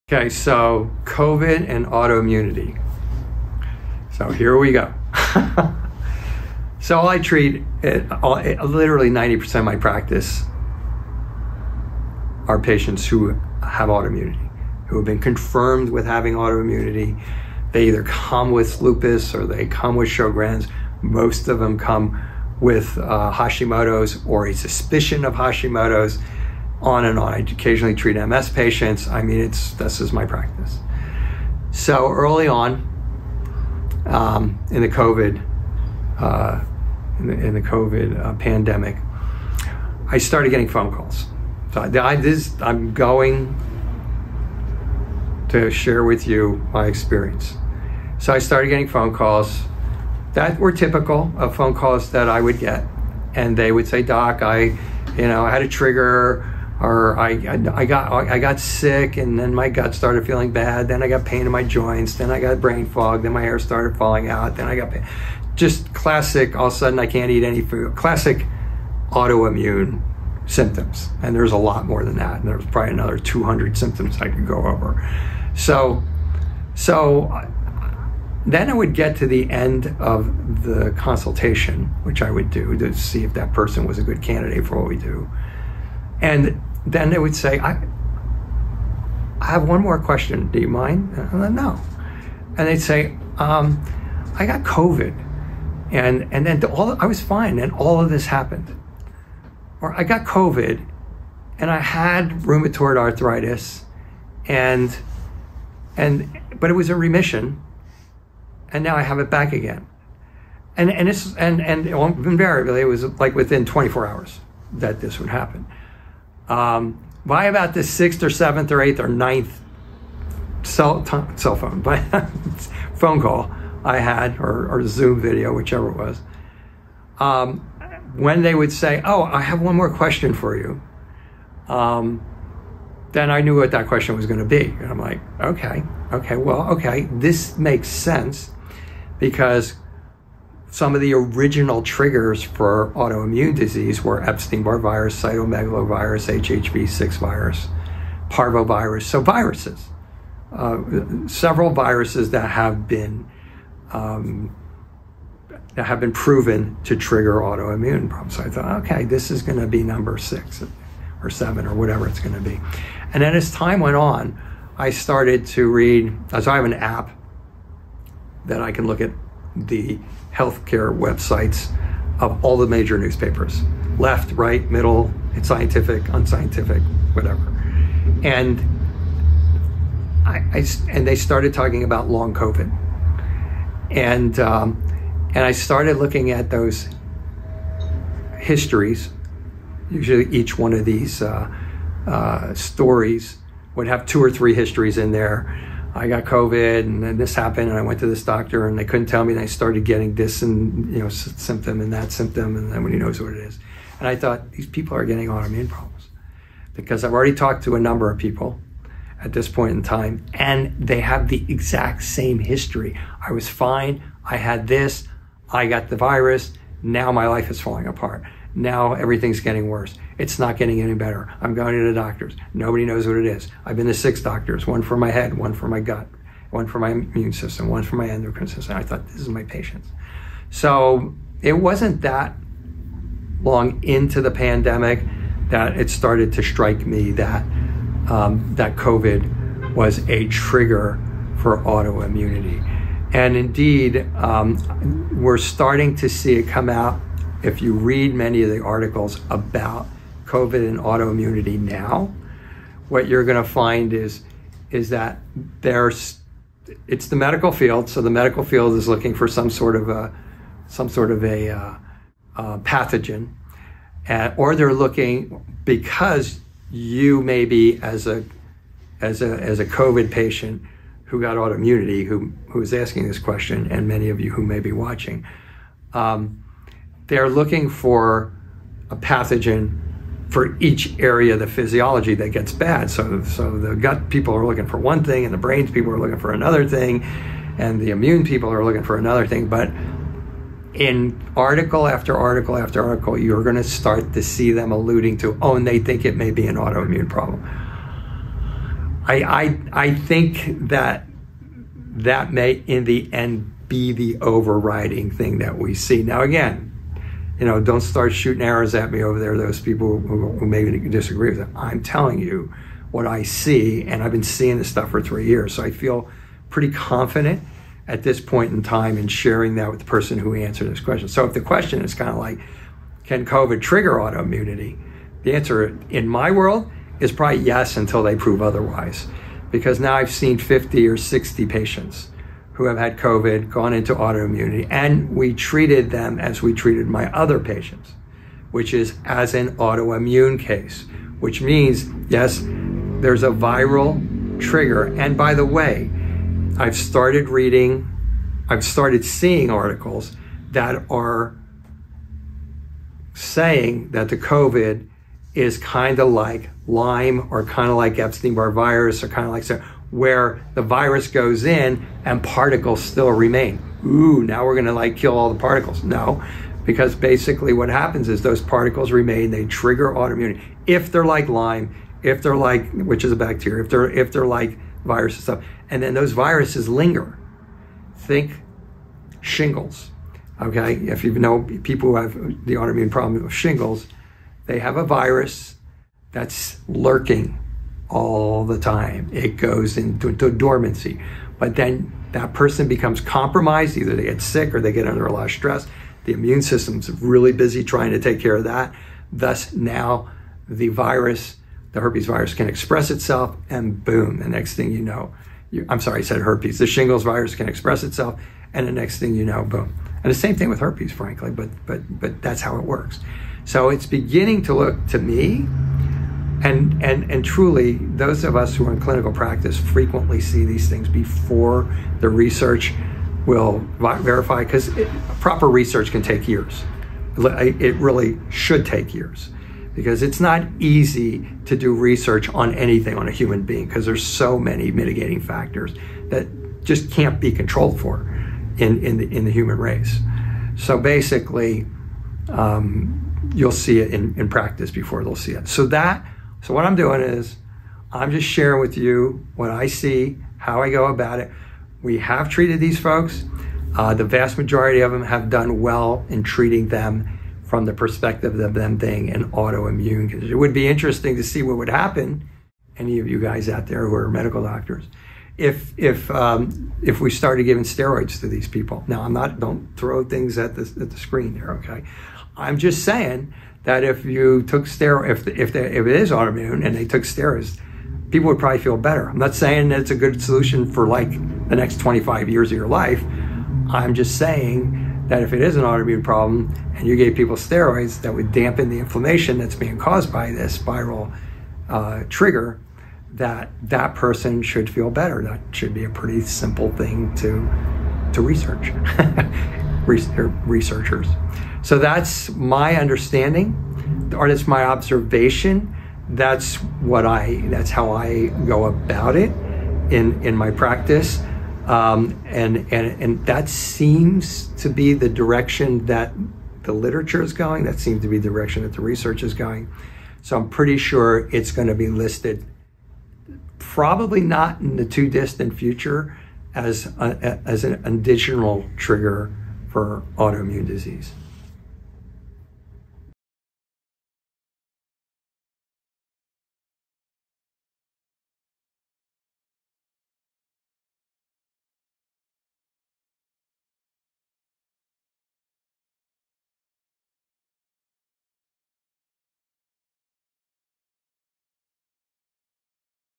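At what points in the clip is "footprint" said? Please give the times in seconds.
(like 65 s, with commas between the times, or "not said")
not said.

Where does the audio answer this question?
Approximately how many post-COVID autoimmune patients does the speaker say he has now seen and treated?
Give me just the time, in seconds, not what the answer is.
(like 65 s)
330 s.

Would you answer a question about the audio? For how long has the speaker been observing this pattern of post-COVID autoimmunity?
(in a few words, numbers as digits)
3 years.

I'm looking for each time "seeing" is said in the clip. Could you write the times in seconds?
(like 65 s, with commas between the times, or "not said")
314 s, 349 s.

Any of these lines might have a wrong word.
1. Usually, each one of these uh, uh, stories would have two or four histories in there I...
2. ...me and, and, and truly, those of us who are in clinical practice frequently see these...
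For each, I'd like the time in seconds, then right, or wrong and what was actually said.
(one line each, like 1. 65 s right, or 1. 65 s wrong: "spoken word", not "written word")
1. 189 s wrong: "three", not "four"
2. 414 s right.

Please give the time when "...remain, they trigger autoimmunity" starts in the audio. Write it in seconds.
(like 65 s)
368 s.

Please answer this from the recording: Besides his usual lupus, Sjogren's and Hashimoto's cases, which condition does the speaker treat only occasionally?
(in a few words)
MS.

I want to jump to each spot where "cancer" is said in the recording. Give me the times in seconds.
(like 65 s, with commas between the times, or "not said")
not said.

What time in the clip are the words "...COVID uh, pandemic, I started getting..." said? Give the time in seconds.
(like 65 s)
37 s.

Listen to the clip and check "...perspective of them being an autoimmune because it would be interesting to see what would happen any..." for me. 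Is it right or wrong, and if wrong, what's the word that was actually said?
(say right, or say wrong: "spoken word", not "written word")
right.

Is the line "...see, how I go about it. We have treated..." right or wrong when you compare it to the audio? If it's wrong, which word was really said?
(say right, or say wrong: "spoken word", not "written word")
right.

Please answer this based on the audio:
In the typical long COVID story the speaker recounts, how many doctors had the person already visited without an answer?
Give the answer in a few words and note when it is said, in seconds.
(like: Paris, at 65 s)
6, at 223 s.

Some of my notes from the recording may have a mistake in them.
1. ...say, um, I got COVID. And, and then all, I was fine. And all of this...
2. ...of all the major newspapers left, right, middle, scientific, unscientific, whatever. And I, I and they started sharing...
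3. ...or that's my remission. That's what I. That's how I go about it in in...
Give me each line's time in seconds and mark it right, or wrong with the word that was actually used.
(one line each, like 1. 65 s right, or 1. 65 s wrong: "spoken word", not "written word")
1. 92 s right
2. 172 s wrong: "talking", not "sharing"
3. 504 s wrong: "observation", not "remission".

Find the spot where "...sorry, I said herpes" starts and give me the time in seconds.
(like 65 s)
405 s.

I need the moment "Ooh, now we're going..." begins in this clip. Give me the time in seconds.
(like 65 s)
363 s.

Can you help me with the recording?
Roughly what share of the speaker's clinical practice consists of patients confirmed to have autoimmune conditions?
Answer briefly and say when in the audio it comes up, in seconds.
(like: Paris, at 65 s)
90%, at 9 s.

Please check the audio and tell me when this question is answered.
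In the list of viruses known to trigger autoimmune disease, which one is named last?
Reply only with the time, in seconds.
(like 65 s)
148 s.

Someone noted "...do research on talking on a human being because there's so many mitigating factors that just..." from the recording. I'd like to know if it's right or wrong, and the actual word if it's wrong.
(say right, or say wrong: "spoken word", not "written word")
wrong: "anything", not "talking".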